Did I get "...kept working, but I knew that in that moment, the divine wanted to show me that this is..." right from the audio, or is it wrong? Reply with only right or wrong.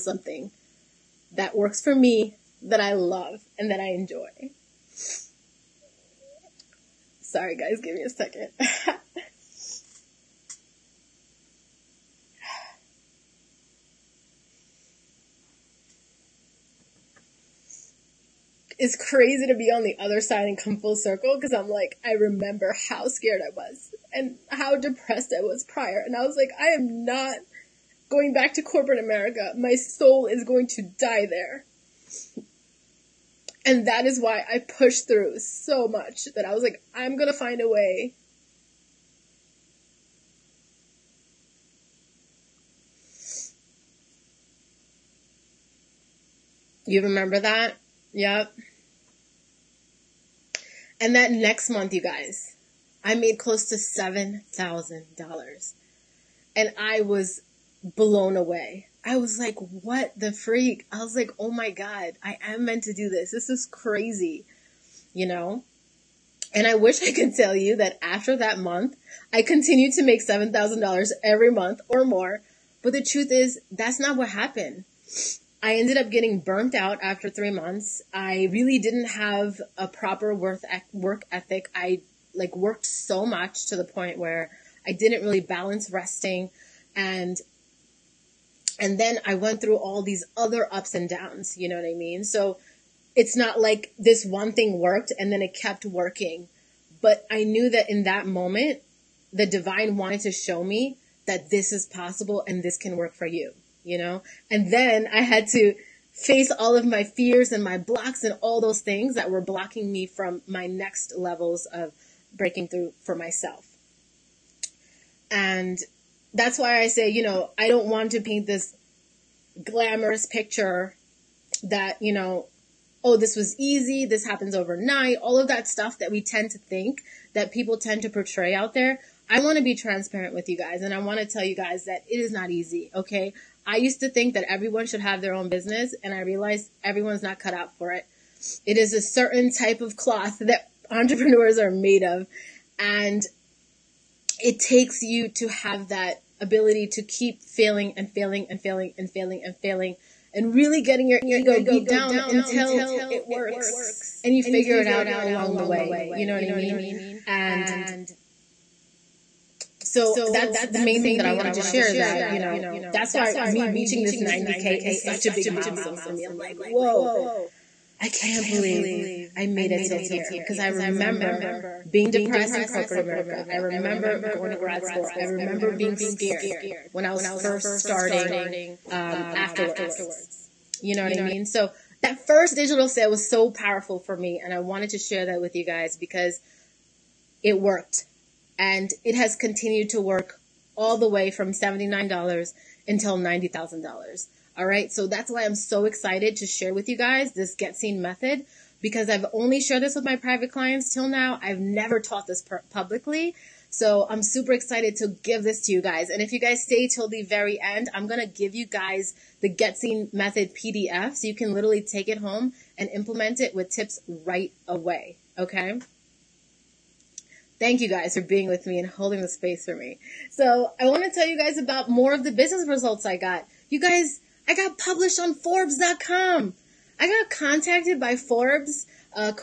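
right.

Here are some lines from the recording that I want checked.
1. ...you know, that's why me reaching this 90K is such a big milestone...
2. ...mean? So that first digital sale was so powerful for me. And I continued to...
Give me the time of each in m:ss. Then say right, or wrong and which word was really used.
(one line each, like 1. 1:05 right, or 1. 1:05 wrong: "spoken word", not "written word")
1. 2:42 right
2. 3:01 wrong: "wanted", not "continued".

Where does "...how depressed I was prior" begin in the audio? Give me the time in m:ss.
0:24.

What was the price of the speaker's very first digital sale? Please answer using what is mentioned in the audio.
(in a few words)
$79.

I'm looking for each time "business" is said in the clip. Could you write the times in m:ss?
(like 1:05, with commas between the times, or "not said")
2:15, 3:42.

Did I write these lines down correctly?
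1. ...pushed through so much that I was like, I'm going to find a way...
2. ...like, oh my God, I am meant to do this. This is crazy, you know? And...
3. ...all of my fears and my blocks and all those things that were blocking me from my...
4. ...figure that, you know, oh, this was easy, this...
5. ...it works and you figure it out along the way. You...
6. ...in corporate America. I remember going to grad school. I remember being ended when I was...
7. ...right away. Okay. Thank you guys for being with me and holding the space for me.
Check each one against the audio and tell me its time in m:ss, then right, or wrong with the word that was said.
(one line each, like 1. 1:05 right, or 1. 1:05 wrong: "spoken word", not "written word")
1. 0:34 right
2. 1:01 right
3. 1:46 right
4. 2:00 wrong: "picture", not "figure"
5. 2:33 right
6. 2:52 wrong: "scared", not "ended"
7. 3:34 right.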